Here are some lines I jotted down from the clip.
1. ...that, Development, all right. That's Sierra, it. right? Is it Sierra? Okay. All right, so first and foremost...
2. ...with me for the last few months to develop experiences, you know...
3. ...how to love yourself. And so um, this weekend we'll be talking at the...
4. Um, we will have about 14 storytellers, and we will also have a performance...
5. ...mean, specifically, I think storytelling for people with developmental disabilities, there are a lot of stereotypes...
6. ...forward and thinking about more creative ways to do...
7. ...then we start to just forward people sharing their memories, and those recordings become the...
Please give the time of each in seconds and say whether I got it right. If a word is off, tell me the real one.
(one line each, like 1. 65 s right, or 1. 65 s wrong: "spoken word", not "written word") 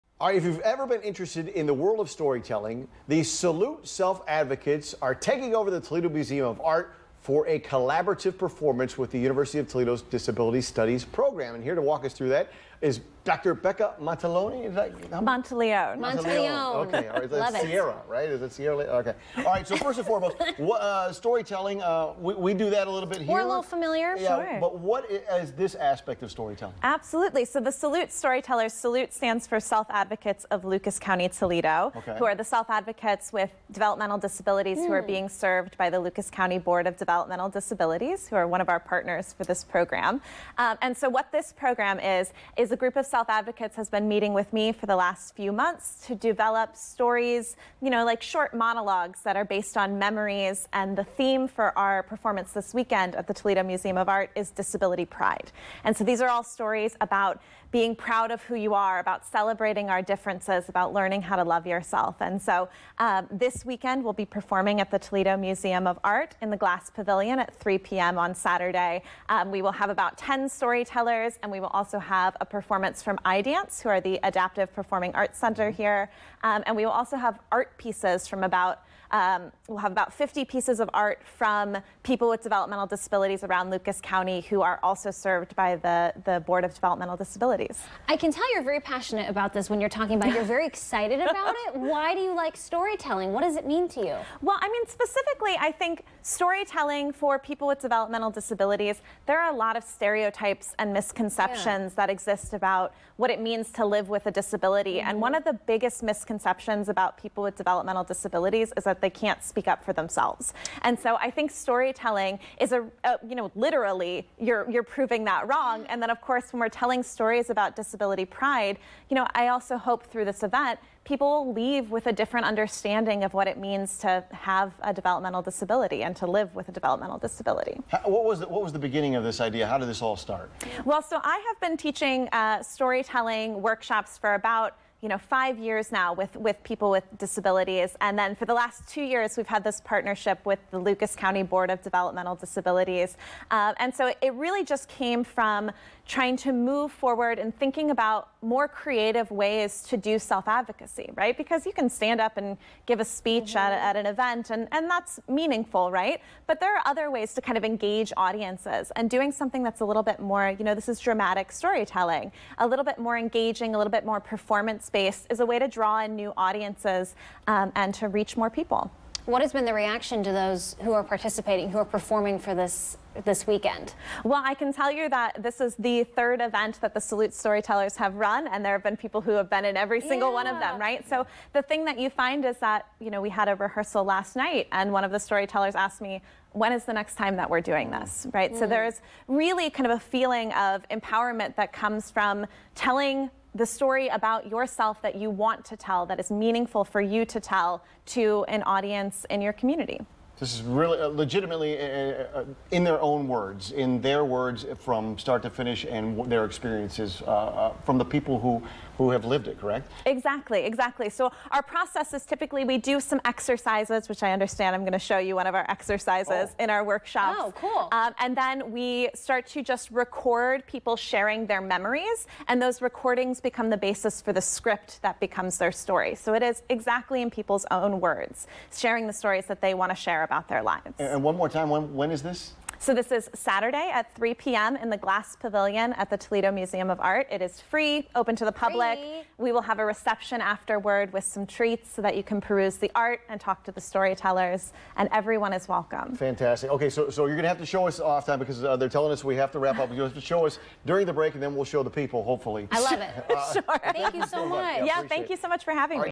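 1. 14 s wrong: "Okay", not "Development"
2. 44 s wrong: "stories", not "experiences"
3. 61 s wrong: "performing", not "talking"
4. 69 s wrong: "10", not "14"
5. 94 s right
6. 146 s right
7. 218 s wrong: "record", not "forward".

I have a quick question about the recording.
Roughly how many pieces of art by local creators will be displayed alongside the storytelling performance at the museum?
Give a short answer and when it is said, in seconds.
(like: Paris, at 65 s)
50, at 80 s.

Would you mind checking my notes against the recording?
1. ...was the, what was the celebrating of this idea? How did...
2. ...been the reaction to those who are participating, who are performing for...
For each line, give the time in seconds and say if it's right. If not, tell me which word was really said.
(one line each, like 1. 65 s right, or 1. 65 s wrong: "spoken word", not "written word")
1. 128 s wrong: "beginning", not "celebrating"
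2. 169 s right.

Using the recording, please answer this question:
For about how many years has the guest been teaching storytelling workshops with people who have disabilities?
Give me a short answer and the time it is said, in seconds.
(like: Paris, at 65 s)
5, at 135 s.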